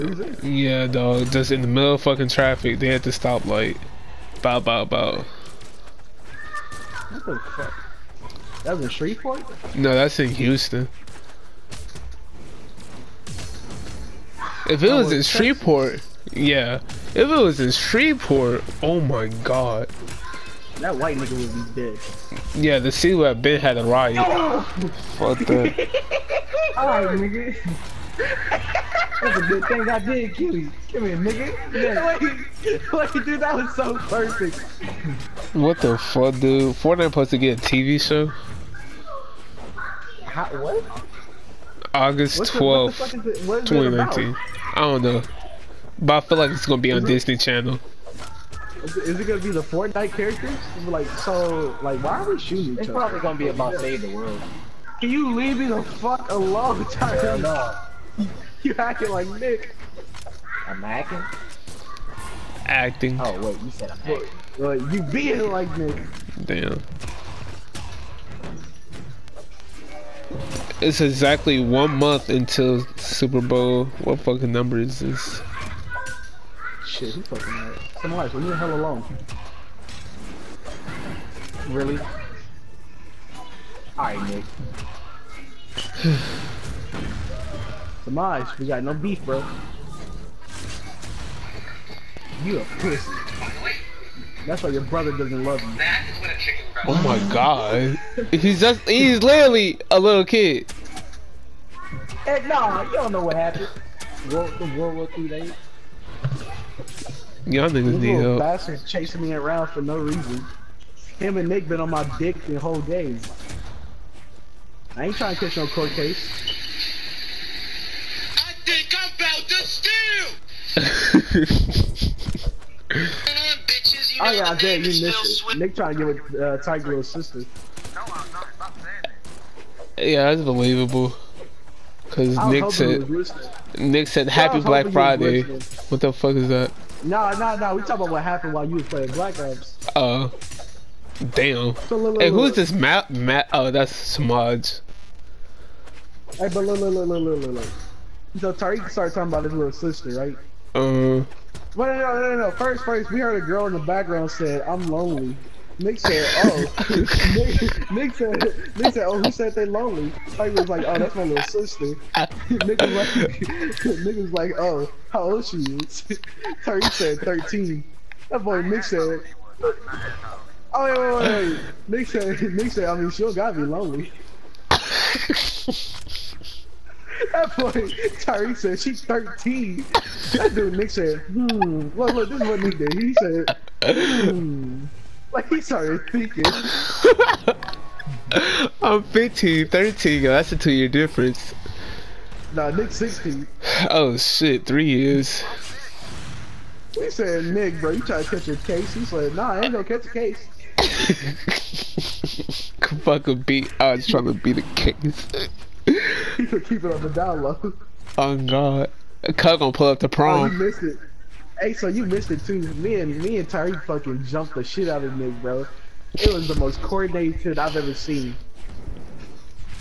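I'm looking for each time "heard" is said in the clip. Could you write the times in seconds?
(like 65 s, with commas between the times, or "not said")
153 s.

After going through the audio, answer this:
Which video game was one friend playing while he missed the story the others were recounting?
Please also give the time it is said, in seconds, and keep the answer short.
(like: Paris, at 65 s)
Black Ops, at 139 s.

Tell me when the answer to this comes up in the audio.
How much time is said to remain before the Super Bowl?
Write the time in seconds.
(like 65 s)
71 s.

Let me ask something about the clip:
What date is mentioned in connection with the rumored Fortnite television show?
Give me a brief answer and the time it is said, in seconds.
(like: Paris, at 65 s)
August 12th, 2019, at 41 s.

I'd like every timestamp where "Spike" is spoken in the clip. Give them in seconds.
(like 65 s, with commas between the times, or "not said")
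160 s.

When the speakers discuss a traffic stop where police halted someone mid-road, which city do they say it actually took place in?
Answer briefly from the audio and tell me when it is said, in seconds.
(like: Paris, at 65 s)
Houston, at 10 s.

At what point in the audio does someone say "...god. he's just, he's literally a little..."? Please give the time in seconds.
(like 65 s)
97 s.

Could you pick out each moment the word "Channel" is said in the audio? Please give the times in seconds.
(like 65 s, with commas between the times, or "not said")
47 s.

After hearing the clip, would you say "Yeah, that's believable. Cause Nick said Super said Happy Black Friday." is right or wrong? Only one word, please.
wrong.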